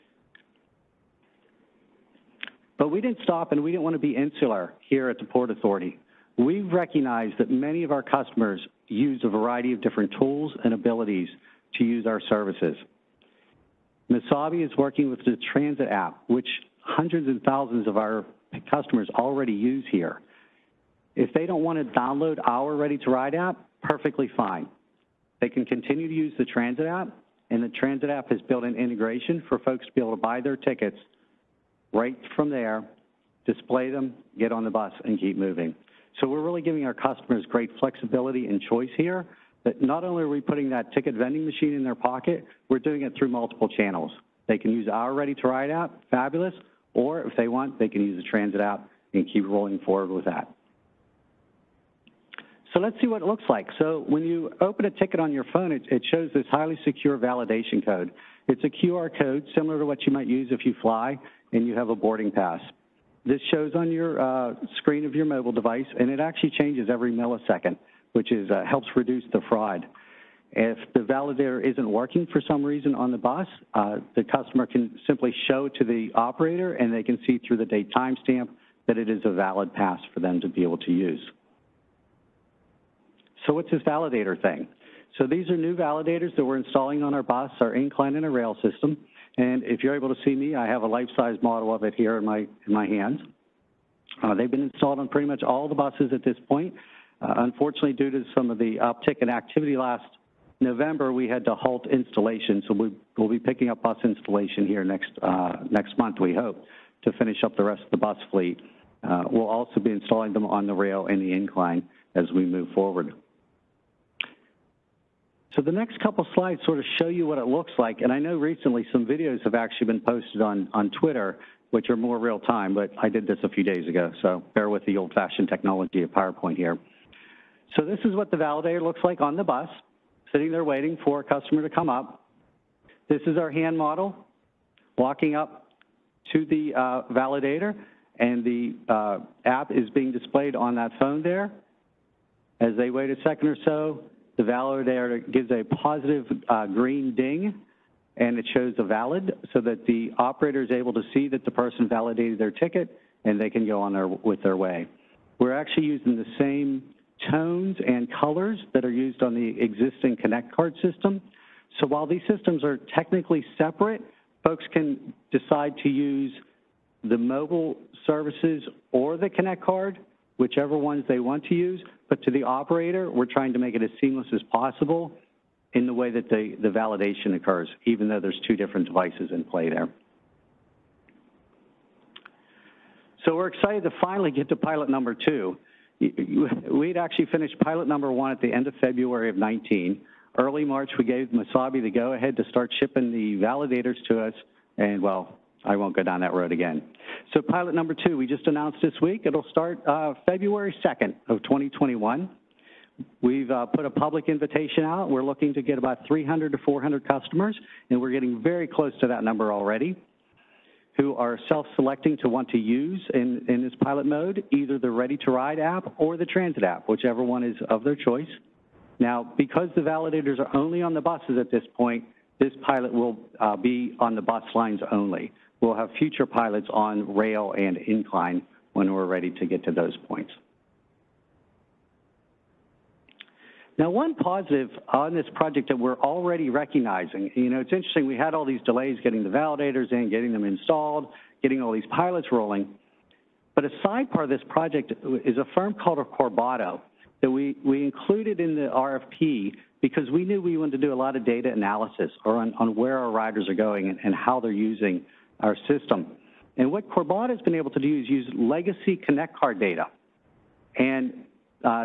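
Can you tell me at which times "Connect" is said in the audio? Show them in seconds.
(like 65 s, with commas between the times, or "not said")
160 s, 169 s, 258 s.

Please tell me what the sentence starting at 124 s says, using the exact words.
So bear with the old fashioned technology of PowerPoint here.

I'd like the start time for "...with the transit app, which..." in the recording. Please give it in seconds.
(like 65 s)
15 s.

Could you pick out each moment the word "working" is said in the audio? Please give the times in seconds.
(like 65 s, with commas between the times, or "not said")
14 s, 71 s.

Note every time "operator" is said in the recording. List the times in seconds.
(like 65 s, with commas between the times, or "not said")
76 s, 150 s, 172 s.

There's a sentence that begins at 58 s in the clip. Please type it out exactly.
It's a QR code similar to what you might use if you fly and you have a boarding pass.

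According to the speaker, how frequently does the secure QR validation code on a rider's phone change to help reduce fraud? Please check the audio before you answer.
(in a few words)
Every millisecond.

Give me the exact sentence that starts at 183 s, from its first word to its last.
So we're excited to finally get to pilot number two.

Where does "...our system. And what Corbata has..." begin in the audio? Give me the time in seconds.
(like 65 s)
255 s.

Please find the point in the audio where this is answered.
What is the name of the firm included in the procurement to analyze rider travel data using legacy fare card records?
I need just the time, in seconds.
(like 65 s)
246 s.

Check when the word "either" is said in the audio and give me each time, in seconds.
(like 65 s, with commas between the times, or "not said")
214 s.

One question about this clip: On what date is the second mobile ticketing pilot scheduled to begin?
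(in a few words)
February 2, 2021.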